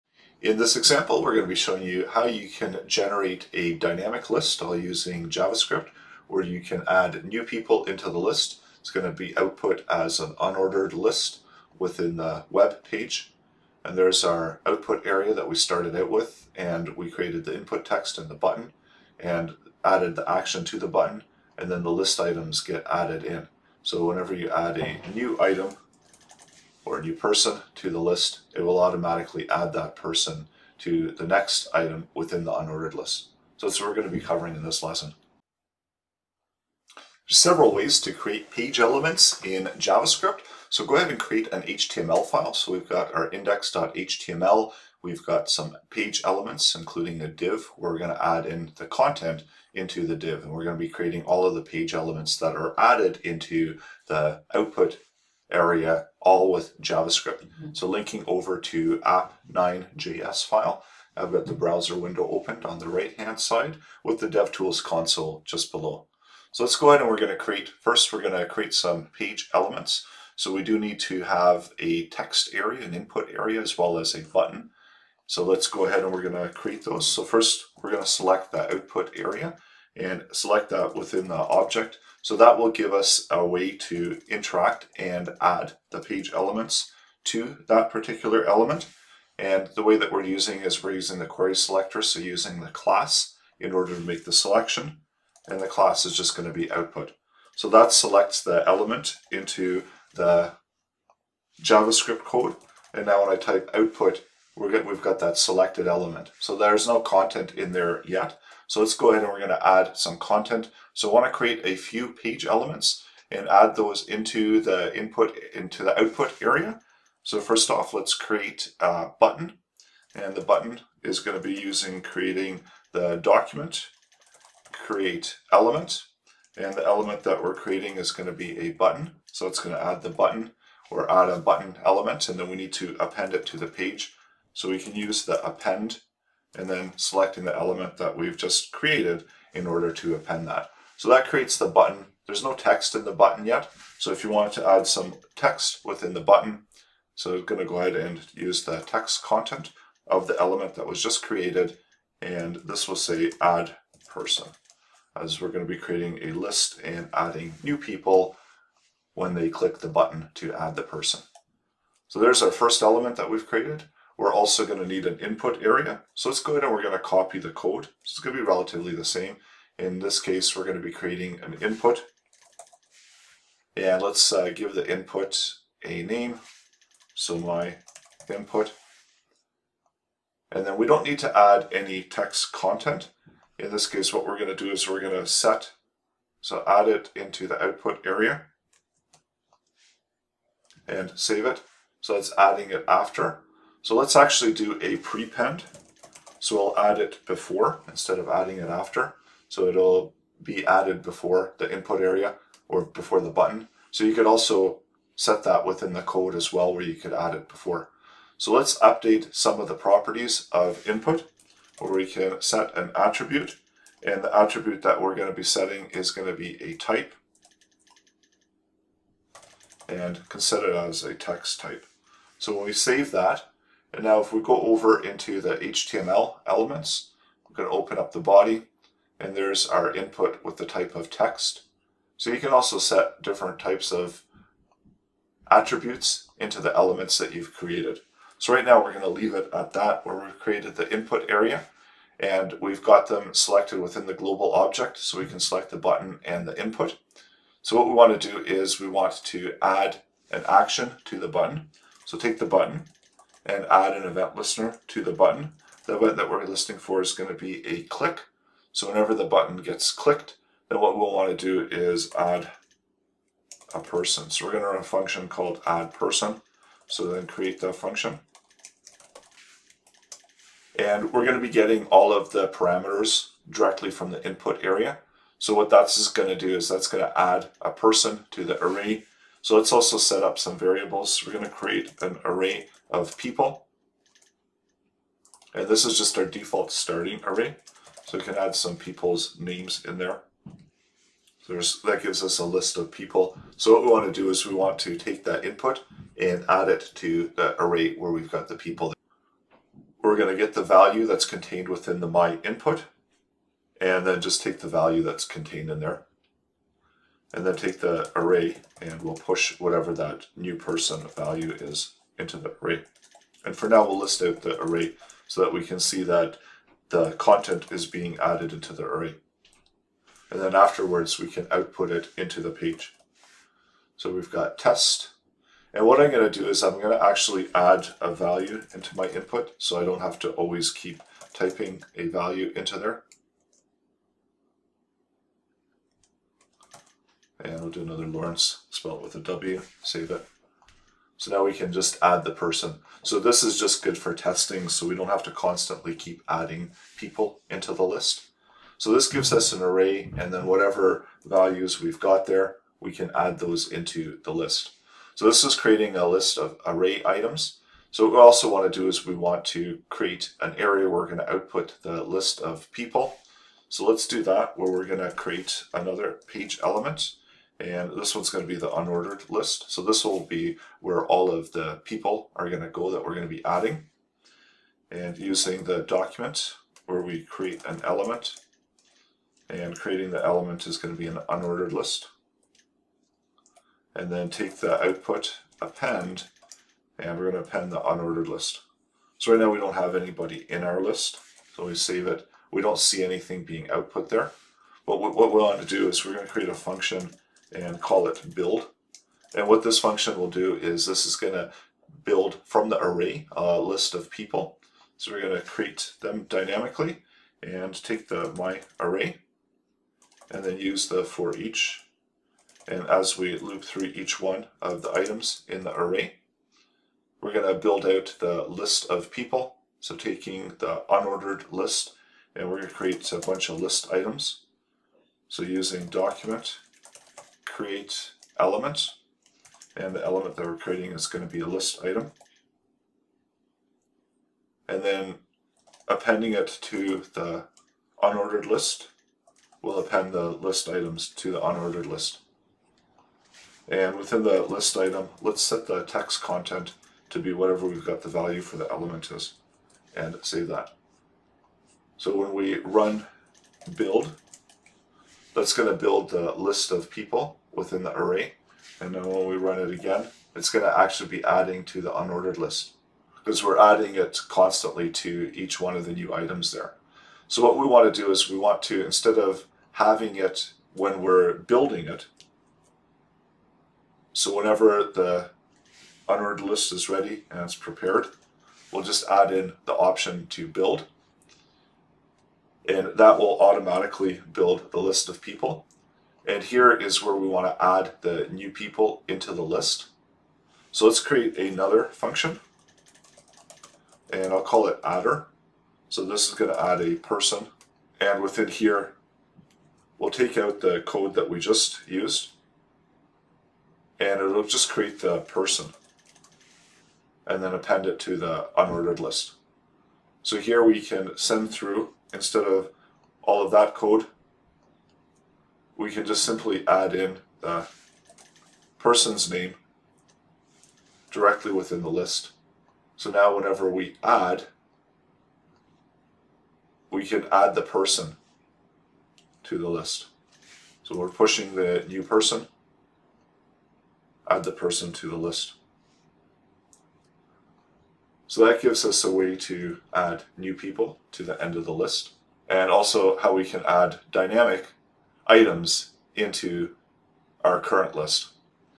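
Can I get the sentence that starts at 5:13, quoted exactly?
And for now, we'll list out the array so that we can see that the content is being added into the array.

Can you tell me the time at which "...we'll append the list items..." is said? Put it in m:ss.
7:19.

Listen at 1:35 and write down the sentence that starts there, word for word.
And the class is just going to be output.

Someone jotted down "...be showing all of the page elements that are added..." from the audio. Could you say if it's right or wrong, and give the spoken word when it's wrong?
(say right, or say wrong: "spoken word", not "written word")
wrong: "creating", not "showing".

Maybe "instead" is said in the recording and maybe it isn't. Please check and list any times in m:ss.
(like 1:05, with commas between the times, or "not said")
3:17, 7:48, 8:32.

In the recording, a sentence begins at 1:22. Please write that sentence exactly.
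So that will give us a way to interact and add the page elements to that particular element.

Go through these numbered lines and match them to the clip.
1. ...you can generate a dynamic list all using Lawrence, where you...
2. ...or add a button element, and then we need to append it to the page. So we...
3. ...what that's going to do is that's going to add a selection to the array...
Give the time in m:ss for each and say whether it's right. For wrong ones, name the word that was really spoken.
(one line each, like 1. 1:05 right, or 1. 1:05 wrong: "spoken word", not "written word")
1. 0:02 wrong: "JavaScript", not "Lawrence"
2. 2:10 right
3. 4:35 wrong: "person", not "selection".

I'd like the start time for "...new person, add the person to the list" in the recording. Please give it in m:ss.
8:51.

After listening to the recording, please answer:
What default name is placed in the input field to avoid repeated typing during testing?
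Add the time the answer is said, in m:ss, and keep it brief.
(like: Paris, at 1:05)
Lawrence, at 5:38.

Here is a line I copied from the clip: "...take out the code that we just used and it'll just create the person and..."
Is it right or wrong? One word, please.
right.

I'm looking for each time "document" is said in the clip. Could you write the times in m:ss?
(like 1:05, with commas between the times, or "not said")
2:03, 6:15, 7:05.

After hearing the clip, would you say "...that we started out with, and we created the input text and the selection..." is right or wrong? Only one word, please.
wrong.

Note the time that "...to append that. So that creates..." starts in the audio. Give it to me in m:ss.
2:19.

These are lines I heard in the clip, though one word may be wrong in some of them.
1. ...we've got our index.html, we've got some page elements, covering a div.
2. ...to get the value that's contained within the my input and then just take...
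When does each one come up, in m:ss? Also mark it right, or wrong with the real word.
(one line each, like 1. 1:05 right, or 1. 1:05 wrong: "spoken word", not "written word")
1. 0:42 wrong: "including", not "covering"
2. 5:00 right.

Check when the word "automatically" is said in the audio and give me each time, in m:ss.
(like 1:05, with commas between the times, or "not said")
0:28, 8:03.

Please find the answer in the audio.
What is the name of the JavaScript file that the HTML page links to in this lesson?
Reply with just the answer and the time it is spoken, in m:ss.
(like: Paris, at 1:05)
app9.js, at 0:58.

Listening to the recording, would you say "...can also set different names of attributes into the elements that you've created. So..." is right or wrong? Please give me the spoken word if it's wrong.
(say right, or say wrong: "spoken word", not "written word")
wrong: "types", not "names".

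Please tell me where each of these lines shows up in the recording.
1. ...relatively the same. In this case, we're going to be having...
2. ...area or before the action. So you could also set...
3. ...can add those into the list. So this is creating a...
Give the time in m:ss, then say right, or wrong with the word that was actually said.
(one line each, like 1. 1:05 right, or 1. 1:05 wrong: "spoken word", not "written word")
1. 2:48 wrong: "creating", not "having"
2. 3:22 wrong: "button", not "action"
3. 5:52 right.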